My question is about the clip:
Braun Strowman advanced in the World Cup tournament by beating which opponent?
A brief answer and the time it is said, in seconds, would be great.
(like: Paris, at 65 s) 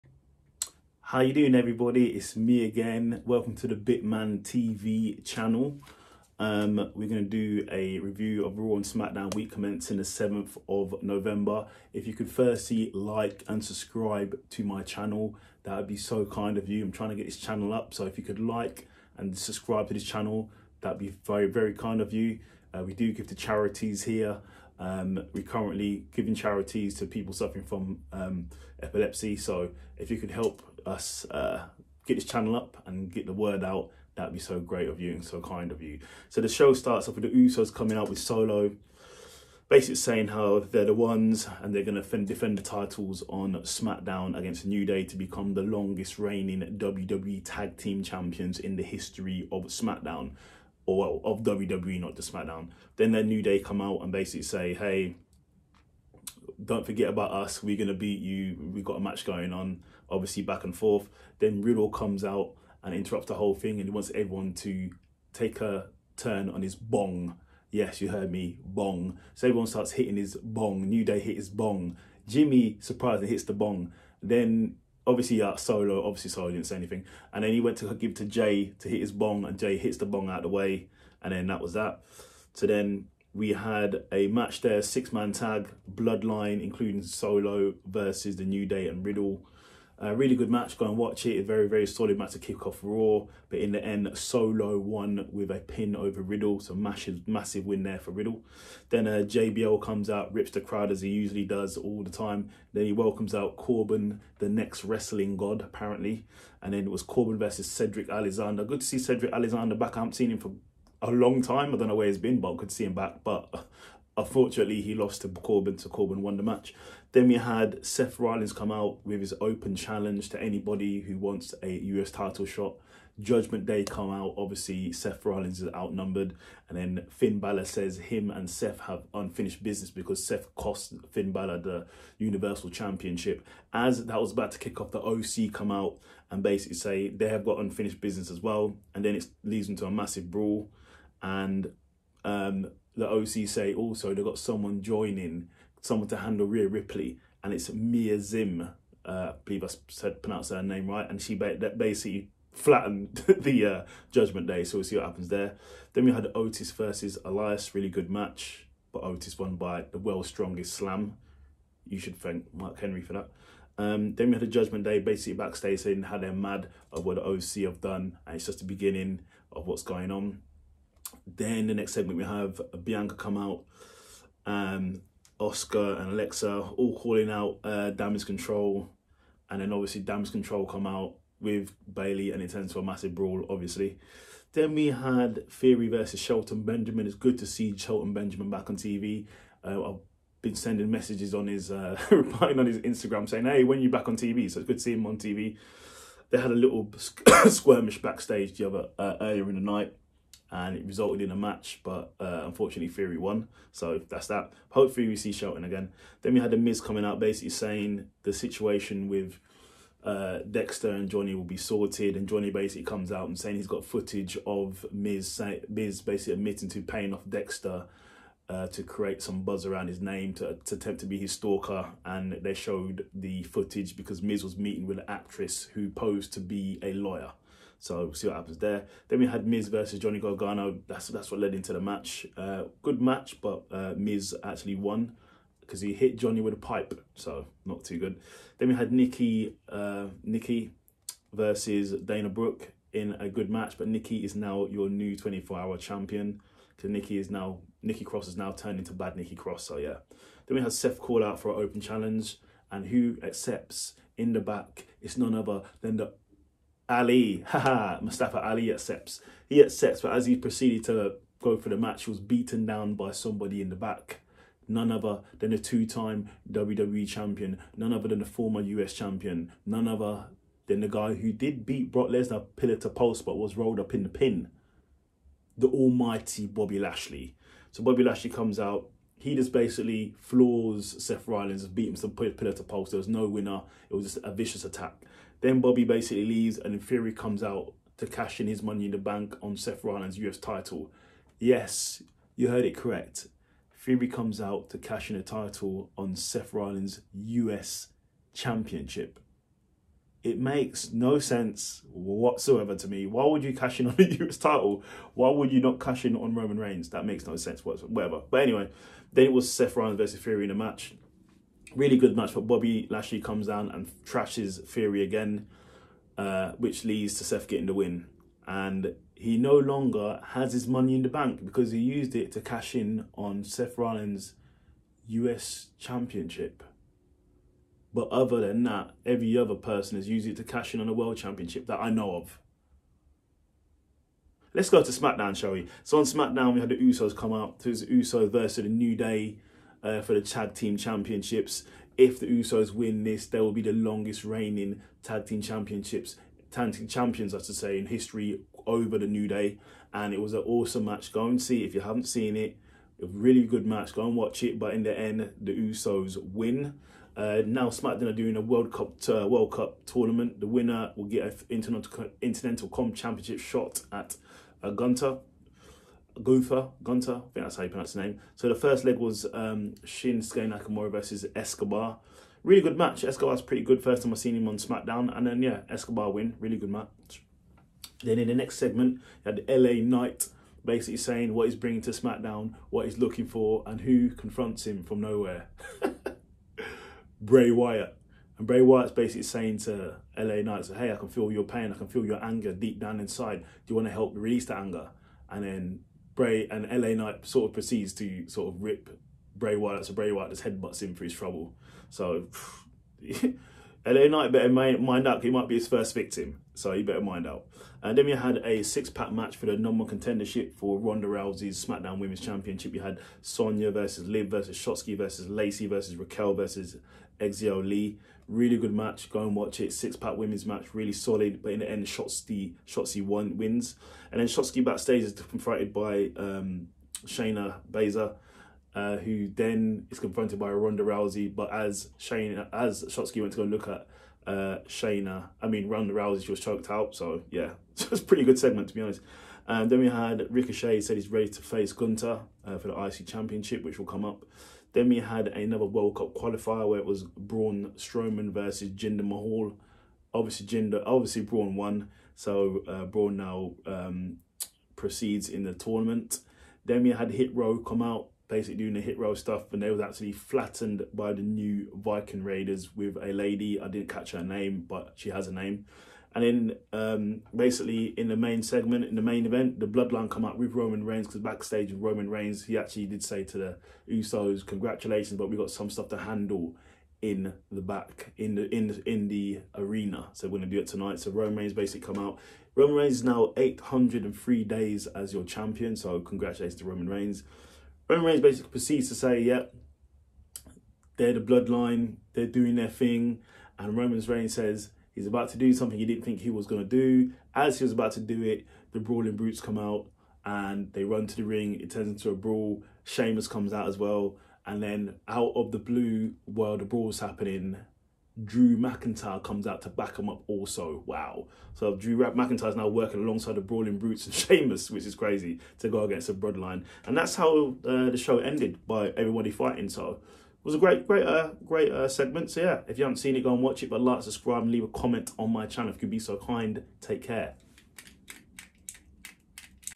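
Jinder Mahal, at 448 s.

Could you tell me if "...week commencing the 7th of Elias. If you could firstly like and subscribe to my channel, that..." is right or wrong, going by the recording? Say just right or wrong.
wrong.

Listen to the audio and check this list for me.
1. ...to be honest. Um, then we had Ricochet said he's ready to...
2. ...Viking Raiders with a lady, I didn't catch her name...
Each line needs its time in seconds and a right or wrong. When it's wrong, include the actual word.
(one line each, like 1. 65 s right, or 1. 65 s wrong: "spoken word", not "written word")
1. 438 s right
2. 461 s right.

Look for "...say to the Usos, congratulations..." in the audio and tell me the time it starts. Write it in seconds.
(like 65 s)
473 s.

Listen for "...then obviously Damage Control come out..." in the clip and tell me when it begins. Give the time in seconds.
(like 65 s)
179 s.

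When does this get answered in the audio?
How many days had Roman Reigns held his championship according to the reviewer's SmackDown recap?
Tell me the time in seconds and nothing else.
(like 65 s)
483 s.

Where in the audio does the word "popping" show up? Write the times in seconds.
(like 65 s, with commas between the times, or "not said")
not said.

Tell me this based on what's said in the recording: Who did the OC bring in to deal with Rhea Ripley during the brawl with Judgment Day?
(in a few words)
Mia Zim.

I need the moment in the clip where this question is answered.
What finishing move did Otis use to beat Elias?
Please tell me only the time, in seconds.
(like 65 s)
159 s.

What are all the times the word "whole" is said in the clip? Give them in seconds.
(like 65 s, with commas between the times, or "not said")
63 s.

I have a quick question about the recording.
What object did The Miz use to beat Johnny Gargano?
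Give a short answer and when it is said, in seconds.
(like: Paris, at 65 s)
a pipe, at 236 s.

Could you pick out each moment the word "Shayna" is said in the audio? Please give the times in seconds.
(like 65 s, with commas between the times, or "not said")
427 s, 434 s.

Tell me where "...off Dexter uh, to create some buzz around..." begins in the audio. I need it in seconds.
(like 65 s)
217 s.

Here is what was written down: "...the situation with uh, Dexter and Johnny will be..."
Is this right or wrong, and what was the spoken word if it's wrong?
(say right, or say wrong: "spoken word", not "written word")
right.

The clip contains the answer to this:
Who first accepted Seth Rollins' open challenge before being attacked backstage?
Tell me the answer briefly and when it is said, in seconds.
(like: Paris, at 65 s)
Mustafa Ali, at 258 s.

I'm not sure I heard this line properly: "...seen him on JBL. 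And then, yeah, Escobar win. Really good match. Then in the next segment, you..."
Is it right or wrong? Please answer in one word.
wrong.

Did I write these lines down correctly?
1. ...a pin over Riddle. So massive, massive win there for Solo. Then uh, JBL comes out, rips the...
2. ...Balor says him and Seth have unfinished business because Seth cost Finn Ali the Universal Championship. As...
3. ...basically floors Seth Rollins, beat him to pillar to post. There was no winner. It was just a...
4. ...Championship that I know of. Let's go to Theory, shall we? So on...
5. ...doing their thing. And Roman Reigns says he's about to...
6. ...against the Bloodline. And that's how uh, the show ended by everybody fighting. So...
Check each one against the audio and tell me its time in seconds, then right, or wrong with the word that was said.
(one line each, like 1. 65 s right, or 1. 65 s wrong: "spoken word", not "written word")
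1. 95 s wrong: "Riddle", not "Solo"
2. 127 s wrong: "Balor", not "Ali"
3. 279 s right
4. 331 s wrong: "SmackDown", not "Theory"
5. 492 s right
6. 515 s right.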